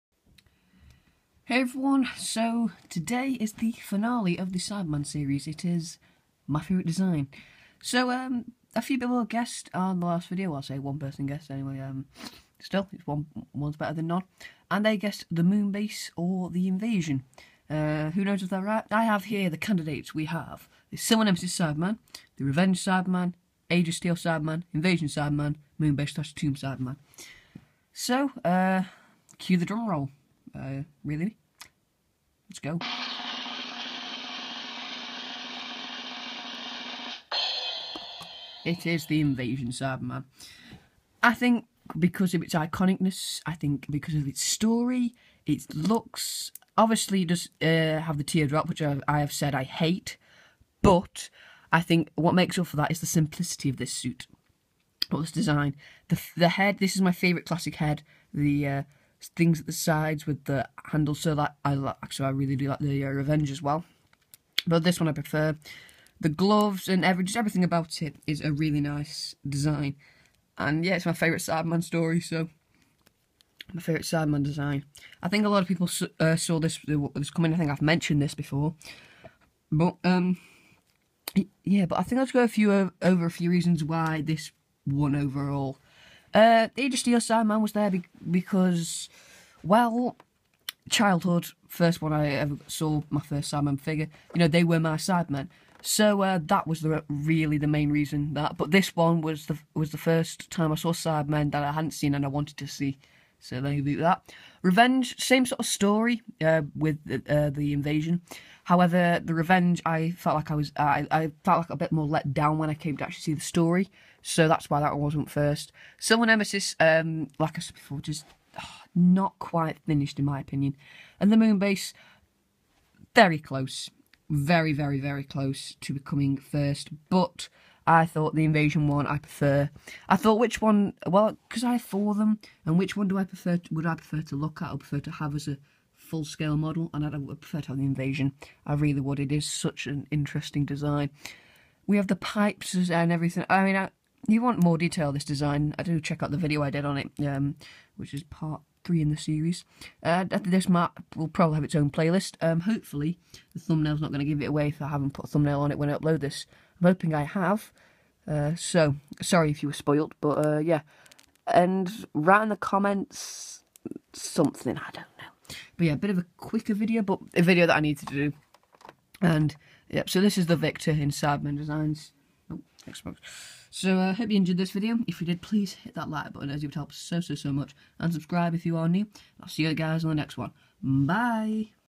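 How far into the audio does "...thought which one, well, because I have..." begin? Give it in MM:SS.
02:10.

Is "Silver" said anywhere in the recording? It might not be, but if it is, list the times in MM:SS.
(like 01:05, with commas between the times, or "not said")
00:20, 01:55.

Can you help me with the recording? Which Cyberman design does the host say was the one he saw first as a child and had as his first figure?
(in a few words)
Industry of Sandman.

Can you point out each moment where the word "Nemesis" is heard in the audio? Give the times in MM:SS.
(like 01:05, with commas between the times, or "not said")
00:21, 01:56.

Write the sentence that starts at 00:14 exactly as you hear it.
And they guessed the moon base or the invasion.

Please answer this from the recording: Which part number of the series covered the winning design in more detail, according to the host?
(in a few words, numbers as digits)
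3.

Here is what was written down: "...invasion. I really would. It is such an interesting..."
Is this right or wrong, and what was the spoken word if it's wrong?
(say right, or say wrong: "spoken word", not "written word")
right.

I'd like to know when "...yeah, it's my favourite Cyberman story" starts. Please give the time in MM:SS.
01:10.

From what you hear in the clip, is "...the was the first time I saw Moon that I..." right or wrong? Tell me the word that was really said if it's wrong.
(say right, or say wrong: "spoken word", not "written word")
wrong: "Cybermen", not "Moon".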